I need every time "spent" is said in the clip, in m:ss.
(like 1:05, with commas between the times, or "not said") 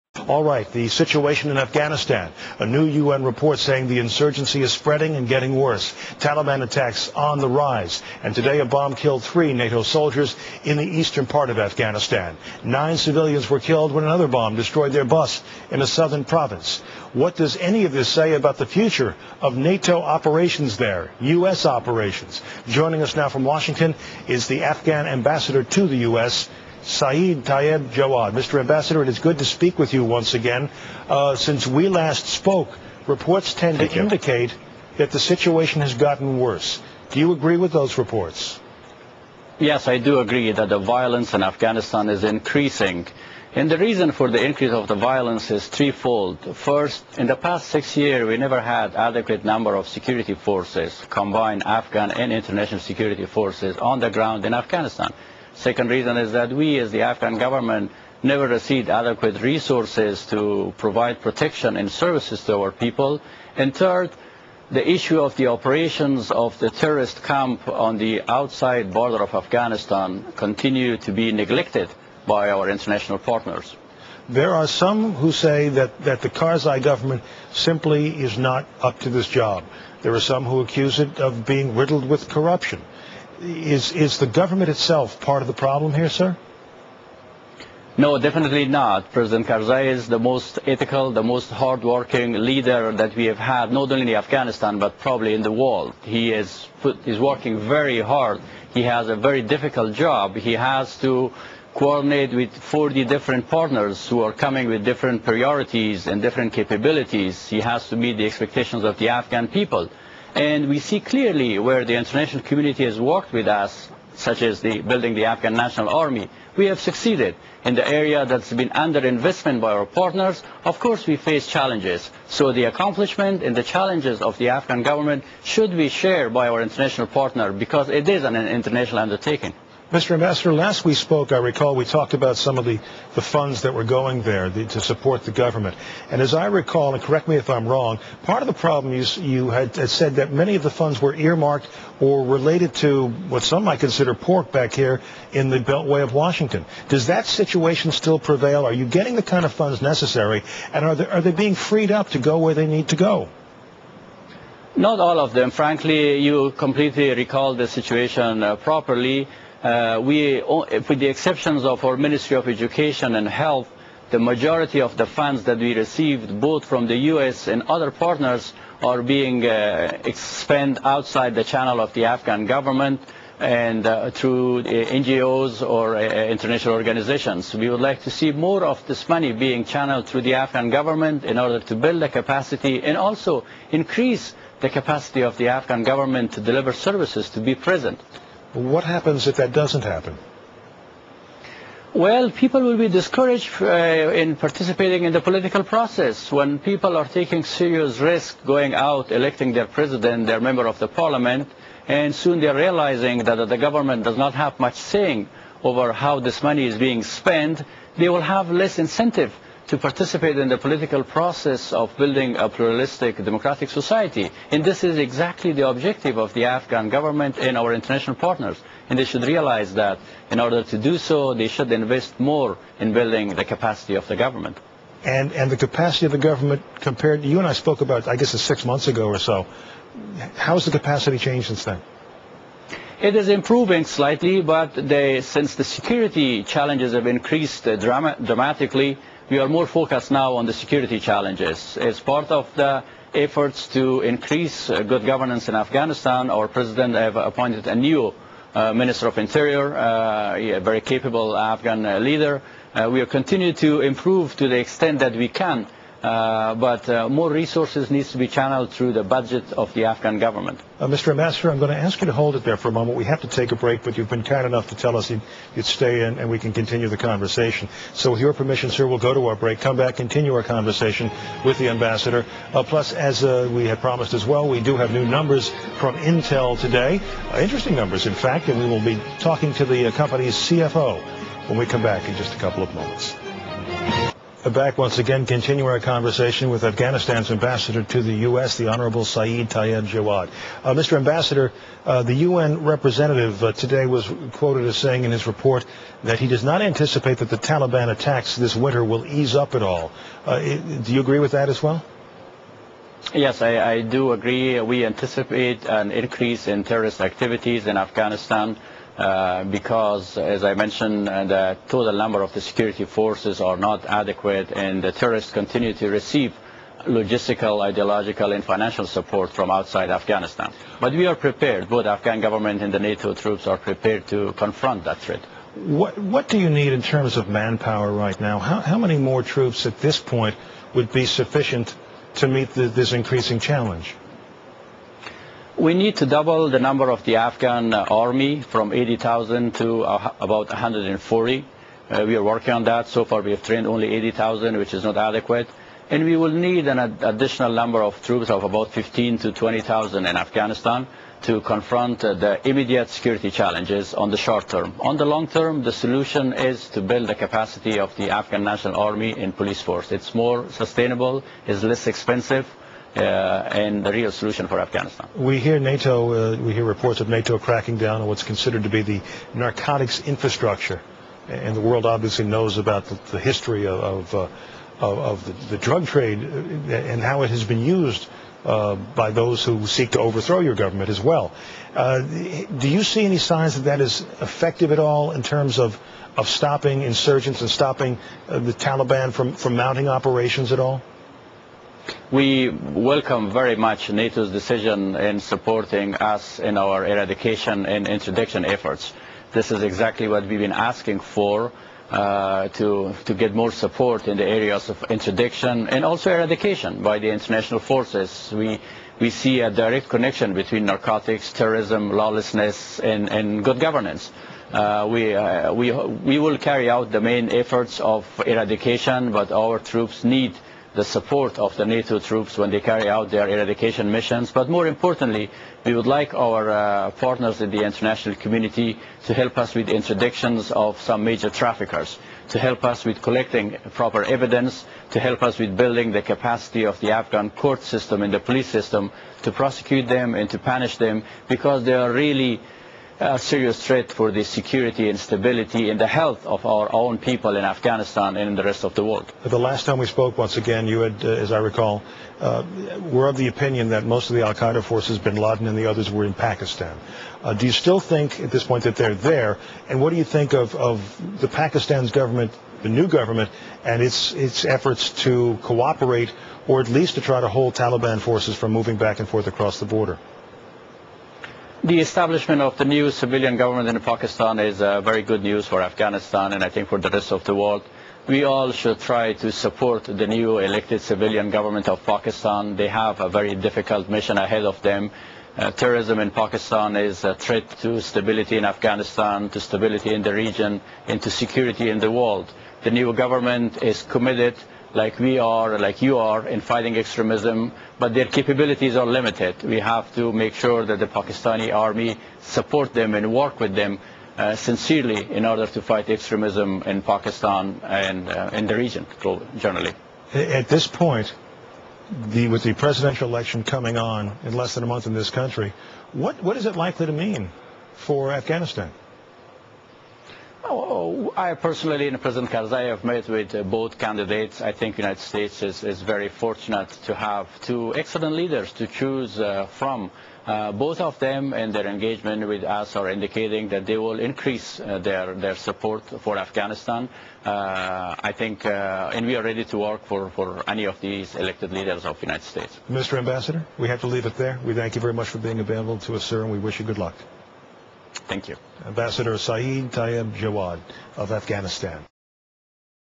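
2:50, 3:27.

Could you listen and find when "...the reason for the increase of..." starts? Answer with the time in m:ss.
0:43.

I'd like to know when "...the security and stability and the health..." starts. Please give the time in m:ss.
7:24.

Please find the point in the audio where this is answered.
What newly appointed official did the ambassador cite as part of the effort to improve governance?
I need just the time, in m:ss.
4:08.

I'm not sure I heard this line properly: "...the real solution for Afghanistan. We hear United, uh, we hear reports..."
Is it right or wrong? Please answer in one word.
wrong.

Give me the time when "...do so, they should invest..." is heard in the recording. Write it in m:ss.
3:40.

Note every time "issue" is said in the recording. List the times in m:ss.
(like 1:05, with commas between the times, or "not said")
1:04.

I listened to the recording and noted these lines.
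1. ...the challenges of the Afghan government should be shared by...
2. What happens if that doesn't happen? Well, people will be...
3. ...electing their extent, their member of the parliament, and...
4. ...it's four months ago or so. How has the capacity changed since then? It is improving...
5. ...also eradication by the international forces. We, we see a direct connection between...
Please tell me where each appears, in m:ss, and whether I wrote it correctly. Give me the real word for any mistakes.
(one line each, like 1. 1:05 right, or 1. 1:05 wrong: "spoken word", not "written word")
1. 2:03 right
2. 3:08 right
3. 3:19 wrong: "president", not "extent"
4. 3:48 wrong: "six", not "four"
5. 6:45 right.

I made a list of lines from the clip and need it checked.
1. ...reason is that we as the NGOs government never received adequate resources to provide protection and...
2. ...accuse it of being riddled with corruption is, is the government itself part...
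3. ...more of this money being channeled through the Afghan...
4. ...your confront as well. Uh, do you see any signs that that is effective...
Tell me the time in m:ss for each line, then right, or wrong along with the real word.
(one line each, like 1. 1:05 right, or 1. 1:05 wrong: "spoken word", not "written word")
1. 0:55 wrong: "Afghan", not "NGOs"
2. 1:20 right
3. 2:58 right
4. 6:20 wrong: "government", not "confront".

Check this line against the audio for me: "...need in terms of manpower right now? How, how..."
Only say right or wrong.
right.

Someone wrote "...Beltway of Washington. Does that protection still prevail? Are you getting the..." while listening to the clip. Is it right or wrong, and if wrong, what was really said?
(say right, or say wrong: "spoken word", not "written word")
wrong: "situation", not "protection".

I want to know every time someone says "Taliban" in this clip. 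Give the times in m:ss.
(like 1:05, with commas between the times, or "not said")
0:06, 4:57, 6:28, 7:47.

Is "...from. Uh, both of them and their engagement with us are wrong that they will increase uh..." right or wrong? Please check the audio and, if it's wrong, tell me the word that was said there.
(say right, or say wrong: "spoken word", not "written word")
wrong: "indicating", not "wrong".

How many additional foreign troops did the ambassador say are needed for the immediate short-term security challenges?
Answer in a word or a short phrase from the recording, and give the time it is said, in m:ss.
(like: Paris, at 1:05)
15,000 to 20,000, at 5:48.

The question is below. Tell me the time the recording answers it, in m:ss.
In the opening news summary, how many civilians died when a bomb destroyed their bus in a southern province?
0:12.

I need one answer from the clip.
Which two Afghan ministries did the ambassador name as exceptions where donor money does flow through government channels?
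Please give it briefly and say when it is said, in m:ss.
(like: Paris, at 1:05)
Education and Health, at 2:42.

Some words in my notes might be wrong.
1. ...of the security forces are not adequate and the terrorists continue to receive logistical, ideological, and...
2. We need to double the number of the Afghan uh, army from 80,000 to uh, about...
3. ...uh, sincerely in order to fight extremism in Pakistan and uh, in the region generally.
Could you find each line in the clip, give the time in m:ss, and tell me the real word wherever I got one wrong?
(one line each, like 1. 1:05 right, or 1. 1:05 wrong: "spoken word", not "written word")
1. 5:12 right
2. 5:35 right
3. 8:24 right.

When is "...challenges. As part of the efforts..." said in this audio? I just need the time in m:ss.
4:00.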